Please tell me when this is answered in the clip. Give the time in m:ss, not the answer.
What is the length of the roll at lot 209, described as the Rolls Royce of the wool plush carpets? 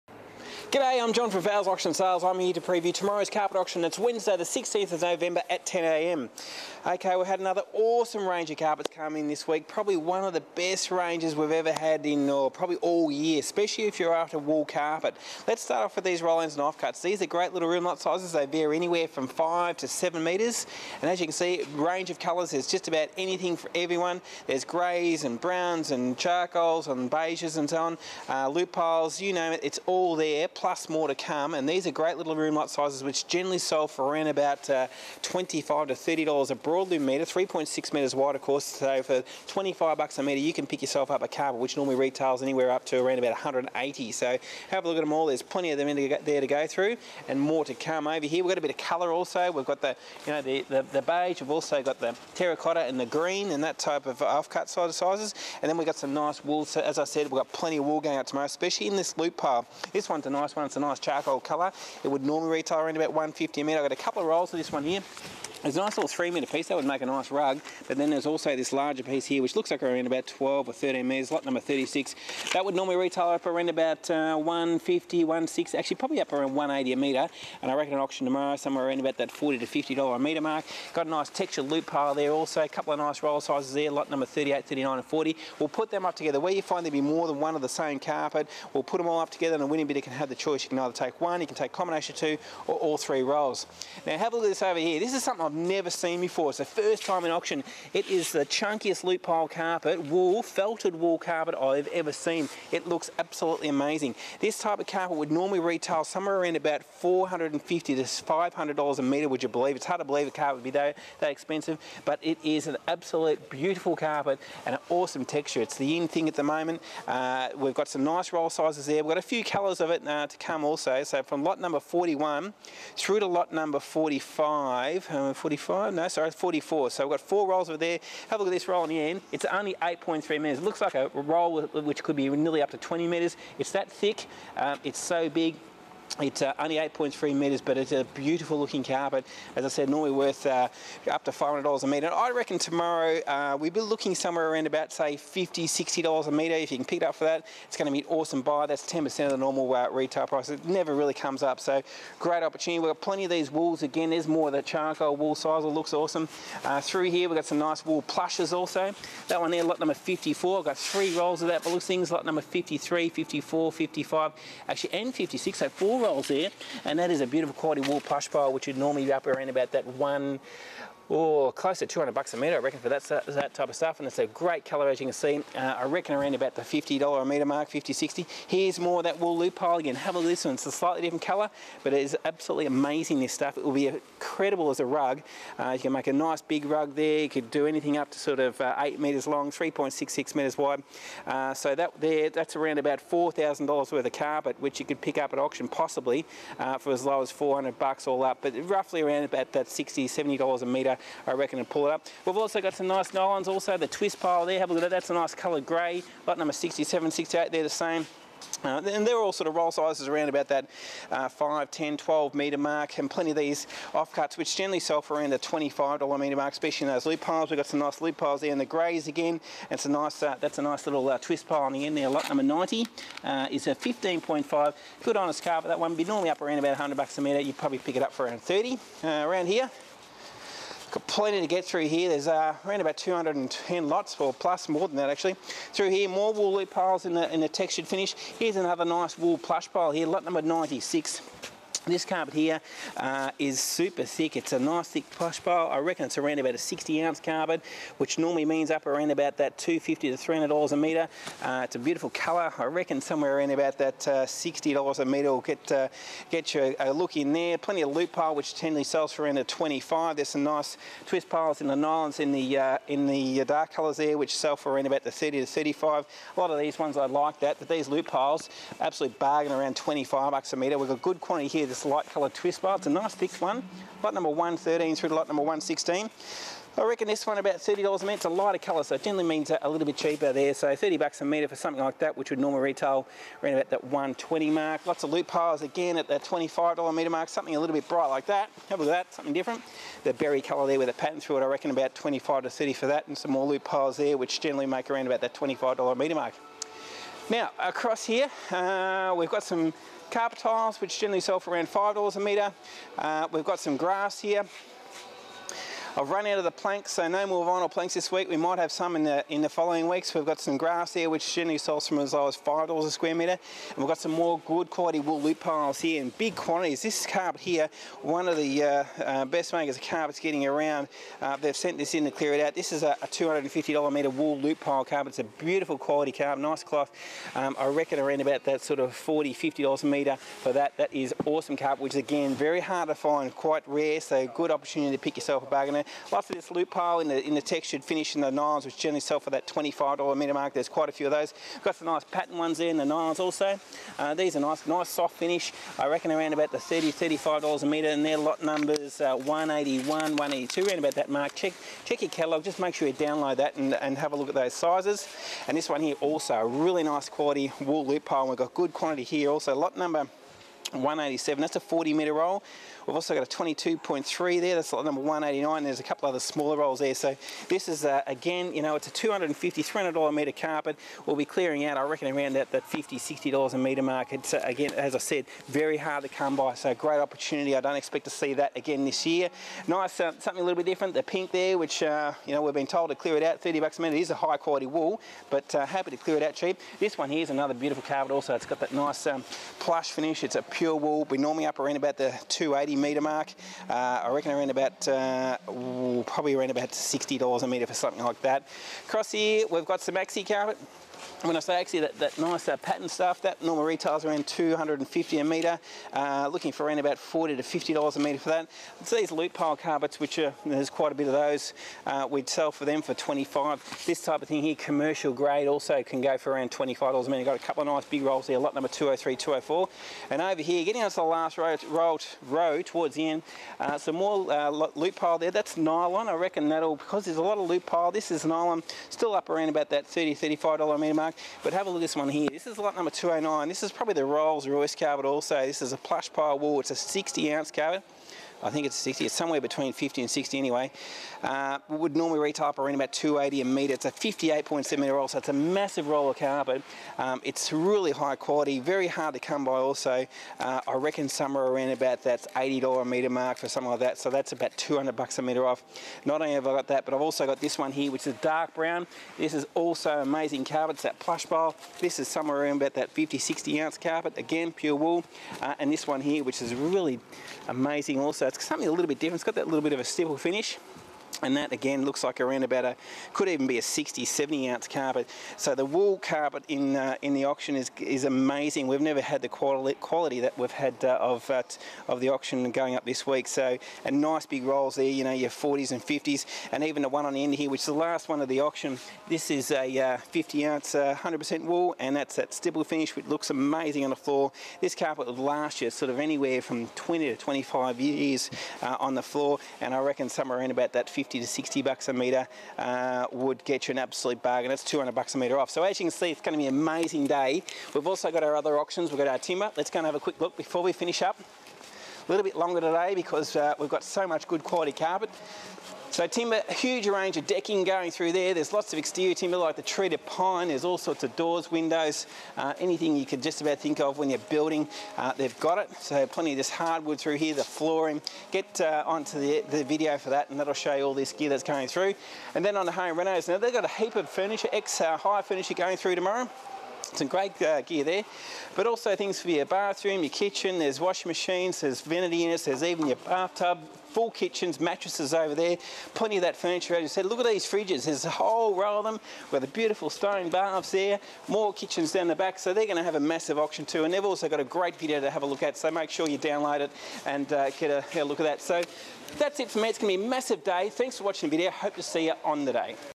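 7:23.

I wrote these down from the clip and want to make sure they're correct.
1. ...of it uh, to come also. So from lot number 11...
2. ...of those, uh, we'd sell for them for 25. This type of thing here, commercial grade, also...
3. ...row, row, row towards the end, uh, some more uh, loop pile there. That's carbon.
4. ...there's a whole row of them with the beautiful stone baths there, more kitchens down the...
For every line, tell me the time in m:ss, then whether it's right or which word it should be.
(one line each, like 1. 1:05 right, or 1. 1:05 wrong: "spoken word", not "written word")
1. 1:59 wrong: "41", not "11"
2. 6:51 right
3. 7:01 wrong: "nylon", not "carbon"
4. 9:07 right.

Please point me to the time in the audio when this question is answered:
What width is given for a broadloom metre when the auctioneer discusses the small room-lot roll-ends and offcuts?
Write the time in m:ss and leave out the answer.
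0:37.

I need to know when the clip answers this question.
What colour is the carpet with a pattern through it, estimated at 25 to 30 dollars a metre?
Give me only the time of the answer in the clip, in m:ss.
4:50.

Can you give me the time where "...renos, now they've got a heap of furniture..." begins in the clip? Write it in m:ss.
8:52.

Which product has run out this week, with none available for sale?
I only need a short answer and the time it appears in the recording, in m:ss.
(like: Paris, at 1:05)
Vinyl planks, at 5:07.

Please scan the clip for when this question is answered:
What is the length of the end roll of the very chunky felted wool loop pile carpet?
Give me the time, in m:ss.
2:09.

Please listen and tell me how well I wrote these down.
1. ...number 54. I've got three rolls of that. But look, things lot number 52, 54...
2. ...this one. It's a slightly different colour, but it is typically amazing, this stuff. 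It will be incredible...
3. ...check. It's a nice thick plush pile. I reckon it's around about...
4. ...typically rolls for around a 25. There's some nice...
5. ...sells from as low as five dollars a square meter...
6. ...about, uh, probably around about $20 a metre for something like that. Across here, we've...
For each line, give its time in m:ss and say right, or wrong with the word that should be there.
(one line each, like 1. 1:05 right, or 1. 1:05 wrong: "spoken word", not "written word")
1. 2:39 wrong: "53", not "52"
2. 3:00 wrong: "absolutely", not "typically"
3. 4:04 wrong: "thick", not "check"
4. 4:18 wrong: "sells", not "rolls"
5. 5:11 right
6. 6:34 wrong: "60", not "20".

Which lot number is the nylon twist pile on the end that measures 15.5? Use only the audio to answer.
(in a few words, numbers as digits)
90.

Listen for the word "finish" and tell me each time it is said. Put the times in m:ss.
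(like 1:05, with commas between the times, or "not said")
3:57, 5:37, 5:45, 6:29, 7:50, 8:12, 8:30.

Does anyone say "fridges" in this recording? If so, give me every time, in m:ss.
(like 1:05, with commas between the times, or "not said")
9:07.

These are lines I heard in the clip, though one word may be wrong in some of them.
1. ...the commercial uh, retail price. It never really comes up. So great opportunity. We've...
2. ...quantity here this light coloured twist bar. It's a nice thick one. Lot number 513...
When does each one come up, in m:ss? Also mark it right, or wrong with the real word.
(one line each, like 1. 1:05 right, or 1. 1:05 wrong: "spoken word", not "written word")
1. 2:29 wrong: "normal", not "commercial"
2. 4:31 wrong: "113", not "513".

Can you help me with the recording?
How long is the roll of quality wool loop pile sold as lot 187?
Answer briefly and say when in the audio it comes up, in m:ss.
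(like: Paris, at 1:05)
40 metres, at 6:01.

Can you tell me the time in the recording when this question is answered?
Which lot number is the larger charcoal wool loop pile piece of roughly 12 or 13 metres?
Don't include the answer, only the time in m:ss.
1:11.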